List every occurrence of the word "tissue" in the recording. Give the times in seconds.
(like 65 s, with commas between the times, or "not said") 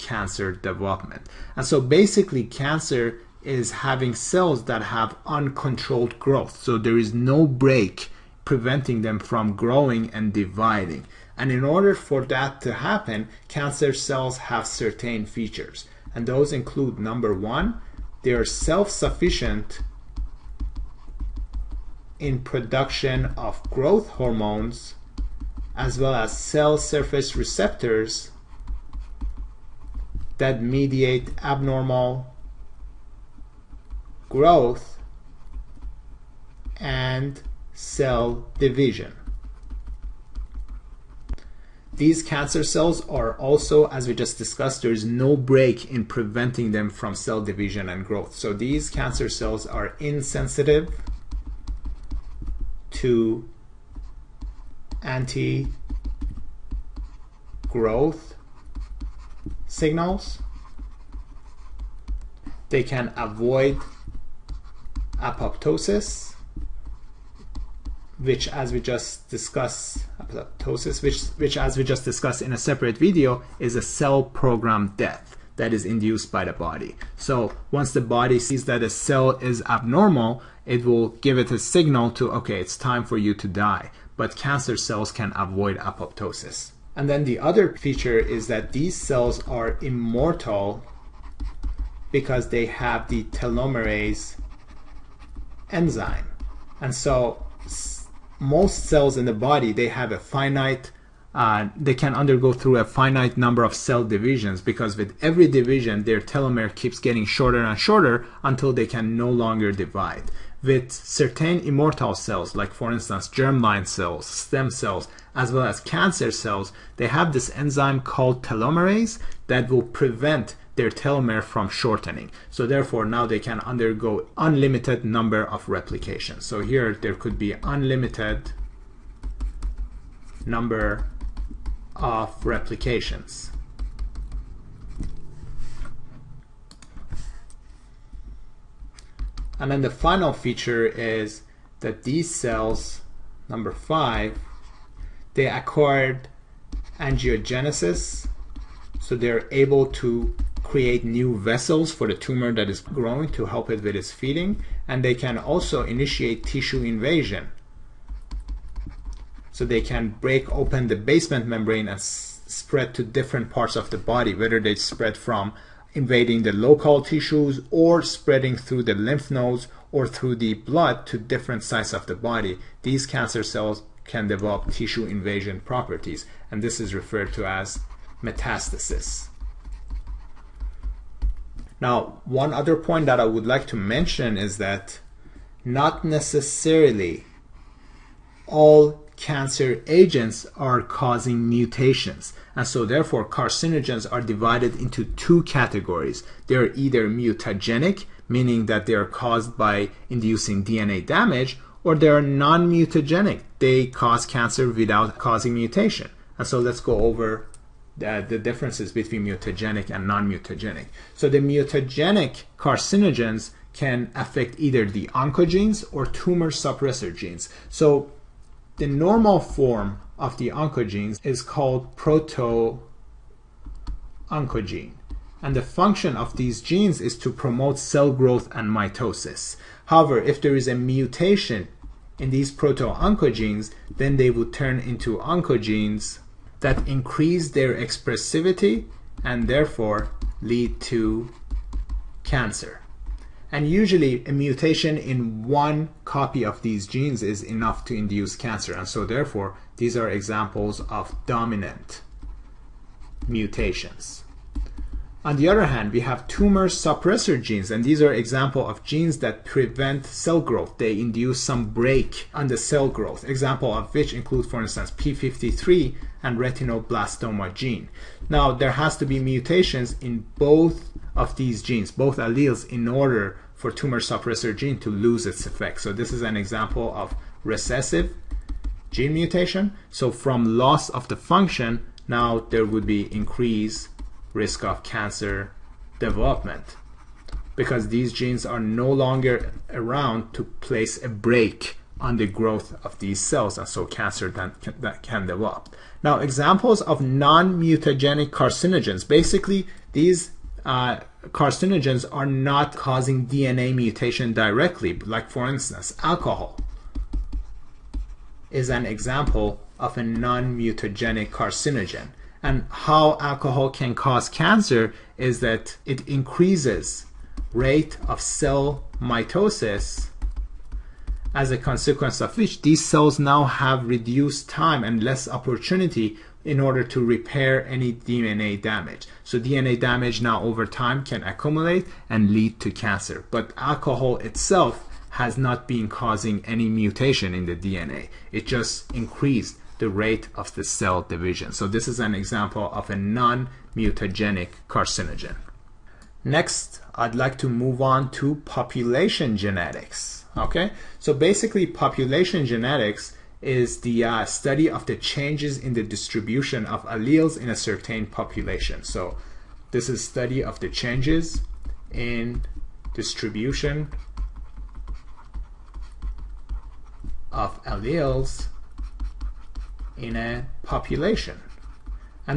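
156 s, 167 s, 174 s.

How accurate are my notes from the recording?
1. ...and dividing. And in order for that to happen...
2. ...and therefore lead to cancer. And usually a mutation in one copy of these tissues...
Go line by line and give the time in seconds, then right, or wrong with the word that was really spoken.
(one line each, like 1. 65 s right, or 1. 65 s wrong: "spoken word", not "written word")
1. 10 s right
2. 239 s wrong: "genes", not "tissues".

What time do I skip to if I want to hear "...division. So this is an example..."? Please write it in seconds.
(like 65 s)
341 s.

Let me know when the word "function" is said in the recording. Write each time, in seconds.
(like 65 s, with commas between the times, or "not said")
225 s, 281 s.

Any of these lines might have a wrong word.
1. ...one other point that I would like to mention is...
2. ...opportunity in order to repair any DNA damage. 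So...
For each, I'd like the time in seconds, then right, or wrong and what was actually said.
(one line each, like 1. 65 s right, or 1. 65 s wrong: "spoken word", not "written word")
1. 182 s right
2. 325 s right.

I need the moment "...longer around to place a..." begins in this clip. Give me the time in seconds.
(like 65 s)
288 s.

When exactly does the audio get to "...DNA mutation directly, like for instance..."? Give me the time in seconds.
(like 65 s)
303 s.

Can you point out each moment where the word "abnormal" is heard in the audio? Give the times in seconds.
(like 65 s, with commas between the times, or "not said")
31 s, 79 s.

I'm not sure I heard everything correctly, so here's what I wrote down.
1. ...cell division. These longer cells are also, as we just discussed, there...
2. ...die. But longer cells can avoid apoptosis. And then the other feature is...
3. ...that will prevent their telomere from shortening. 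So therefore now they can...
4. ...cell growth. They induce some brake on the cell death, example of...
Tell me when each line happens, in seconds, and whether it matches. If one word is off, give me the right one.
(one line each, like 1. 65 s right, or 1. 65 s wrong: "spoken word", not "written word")
1. 37 s wrong: "cancer", not "longer"
2. 83 s wrong: "cancer", not "longer"
3. 119 s right
4. 260 s wrong: "growth", not "death".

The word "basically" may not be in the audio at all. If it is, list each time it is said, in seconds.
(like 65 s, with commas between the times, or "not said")
1 s, 299 s, 351 s.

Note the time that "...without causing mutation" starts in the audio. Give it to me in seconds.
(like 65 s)
204 s.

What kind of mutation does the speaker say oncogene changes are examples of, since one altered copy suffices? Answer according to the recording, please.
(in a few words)
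dominant mutations.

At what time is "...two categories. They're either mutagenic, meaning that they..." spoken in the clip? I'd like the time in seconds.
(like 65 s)
195 s.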